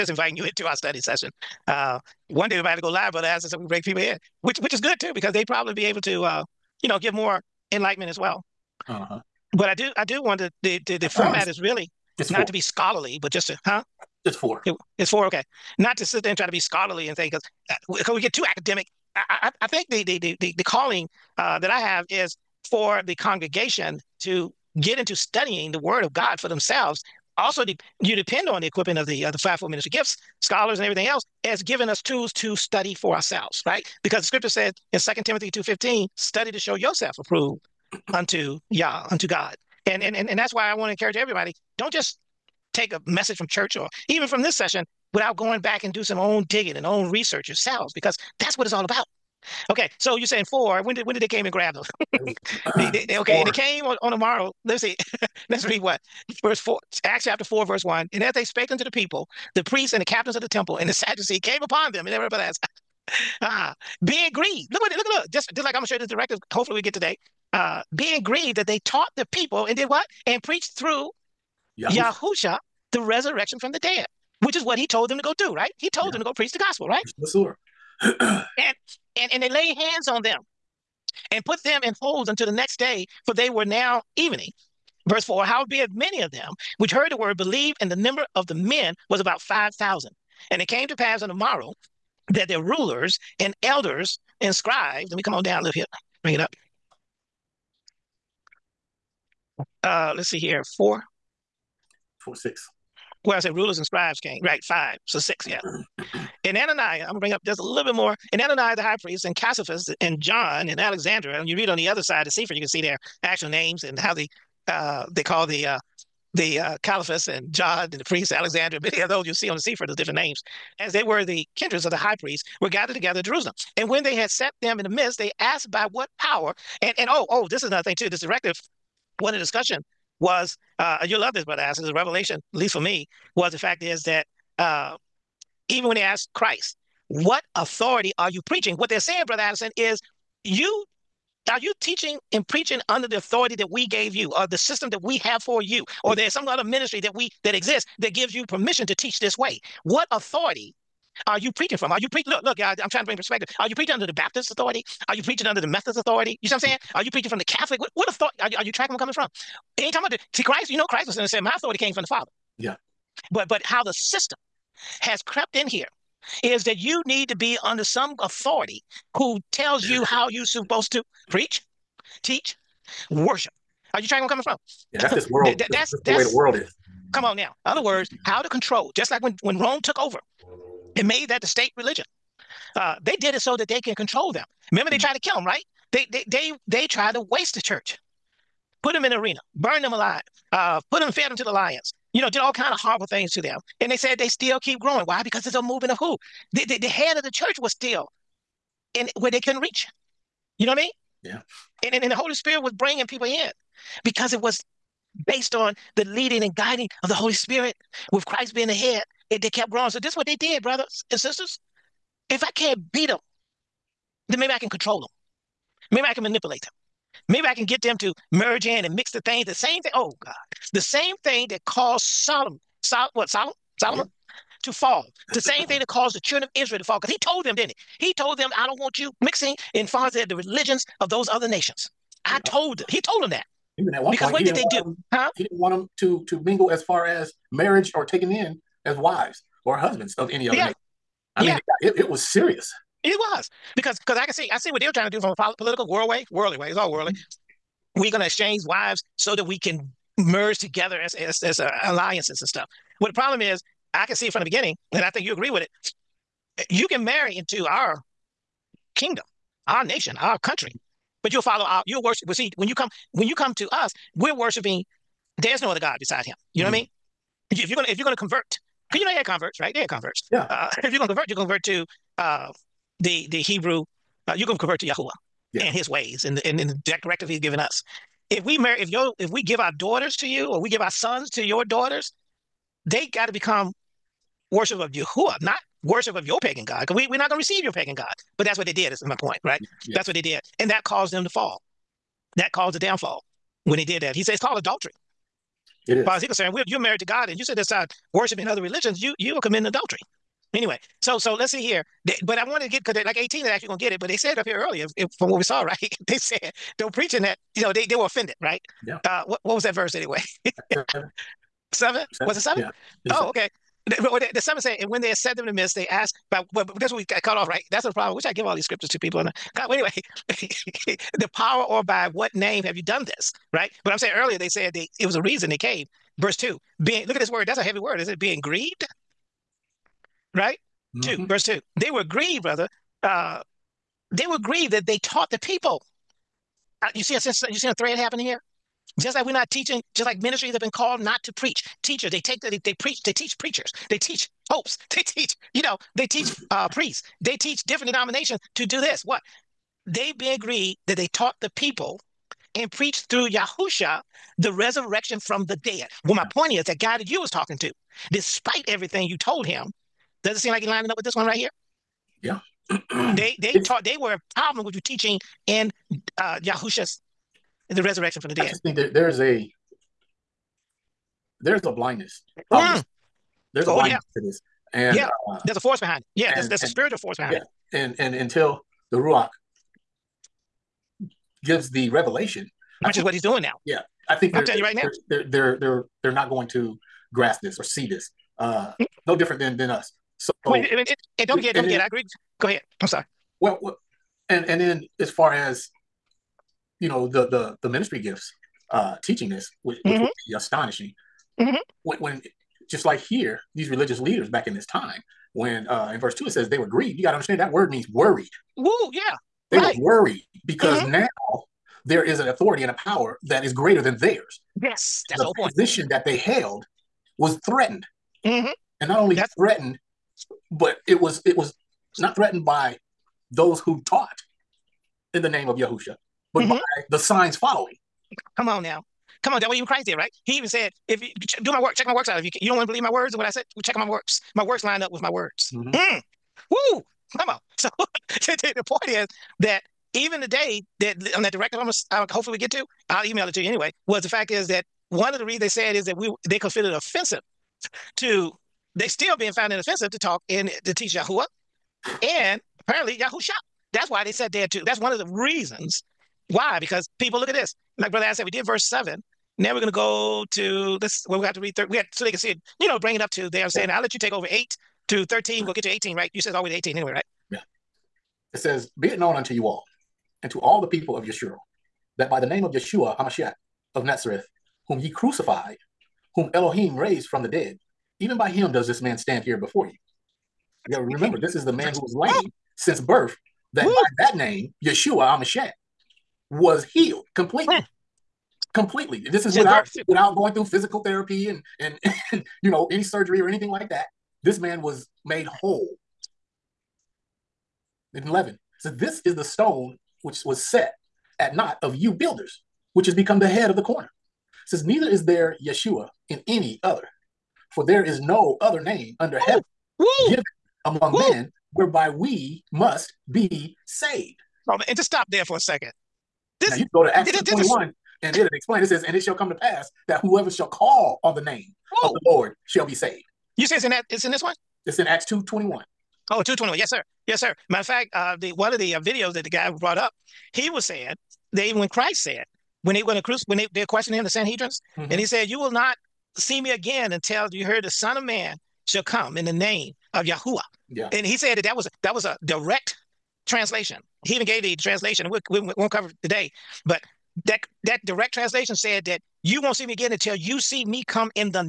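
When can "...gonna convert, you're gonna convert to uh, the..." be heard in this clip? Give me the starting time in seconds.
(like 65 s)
270 s.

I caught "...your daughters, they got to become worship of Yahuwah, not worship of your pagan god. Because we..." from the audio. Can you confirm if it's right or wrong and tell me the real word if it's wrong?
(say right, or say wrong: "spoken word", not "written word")
right.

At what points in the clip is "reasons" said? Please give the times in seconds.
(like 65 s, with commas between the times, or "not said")
325 s, 445 s, 455 s.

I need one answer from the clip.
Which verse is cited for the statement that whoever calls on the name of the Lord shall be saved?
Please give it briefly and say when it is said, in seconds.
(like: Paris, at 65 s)
Acts 2:21, at 524 s.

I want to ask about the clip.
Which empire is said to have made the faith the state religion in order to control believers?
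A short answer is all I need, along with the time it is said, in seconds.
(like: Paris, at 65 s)
Rome, at 179 s.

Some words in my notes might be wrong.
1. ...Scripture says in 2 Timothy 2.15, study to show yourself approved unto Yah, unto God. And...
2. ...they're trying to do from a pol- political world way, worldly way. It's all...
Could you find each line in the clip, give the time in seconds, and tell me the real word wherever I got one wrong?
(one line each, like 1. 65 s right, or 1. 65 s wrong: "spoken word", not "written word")
1. 34 s right
2. 244 s right.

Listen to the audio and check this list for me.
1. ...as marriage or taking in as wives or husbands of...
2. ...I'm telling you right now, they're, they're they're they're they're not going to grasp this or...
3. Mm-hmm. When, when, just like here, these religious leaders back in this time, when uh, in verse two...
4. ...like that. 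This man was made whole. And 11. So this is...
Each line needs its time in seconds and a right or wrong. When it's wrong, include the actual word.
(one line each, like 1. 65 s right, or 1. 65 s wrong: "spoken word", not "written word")
1. 237 s right
2. 384 s right
3. 401 s right
4. 493 s right.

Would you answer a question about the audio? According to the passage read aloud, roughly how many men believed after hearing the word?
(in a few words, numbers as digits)
5,000.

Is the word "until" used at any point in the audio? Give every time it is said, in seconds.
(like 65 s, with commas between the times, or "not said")
82 s, 378 s, 536 s, 549 s.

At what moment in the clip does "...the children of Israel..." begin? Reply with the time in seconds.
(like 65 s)
226 s.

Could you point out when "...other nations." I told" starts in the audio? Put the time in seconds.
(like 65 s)
231 s.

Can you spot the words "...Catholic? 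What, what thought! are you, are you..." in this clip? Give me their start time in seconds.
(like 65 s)
157 s.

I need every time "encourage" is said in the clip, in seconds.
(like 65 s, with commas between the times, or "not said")
40 s.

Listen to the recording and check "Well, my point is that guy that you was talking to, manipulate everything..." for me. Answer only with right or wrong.
wrong.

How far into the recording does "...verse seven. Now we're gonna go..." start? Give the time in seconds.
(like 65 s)
458 s.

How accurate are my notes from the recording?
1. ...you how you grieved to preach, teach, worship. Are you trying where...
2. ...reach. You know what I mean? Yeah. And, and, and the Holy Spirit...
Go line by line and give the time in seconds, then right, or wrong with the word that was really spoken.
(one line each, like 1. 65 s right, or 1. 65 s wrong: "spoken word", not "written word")
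1. 169 s wrong: "supposed", not "grieved"
2. 199 s right.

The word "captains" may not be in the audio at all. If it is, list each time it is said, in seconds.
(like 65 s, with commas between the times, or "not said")
60 s.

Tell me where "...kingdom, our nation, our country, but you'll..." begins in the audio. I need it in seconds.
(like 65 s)
258 s.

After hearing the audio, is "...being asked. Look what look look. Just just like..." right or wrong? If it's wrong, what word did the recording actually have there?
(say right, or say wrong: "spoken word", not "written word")
wrong: "grieved", not "asked".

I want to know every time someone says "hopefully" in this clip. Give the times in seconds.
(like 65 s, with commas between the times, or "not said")
66 s, 442 s.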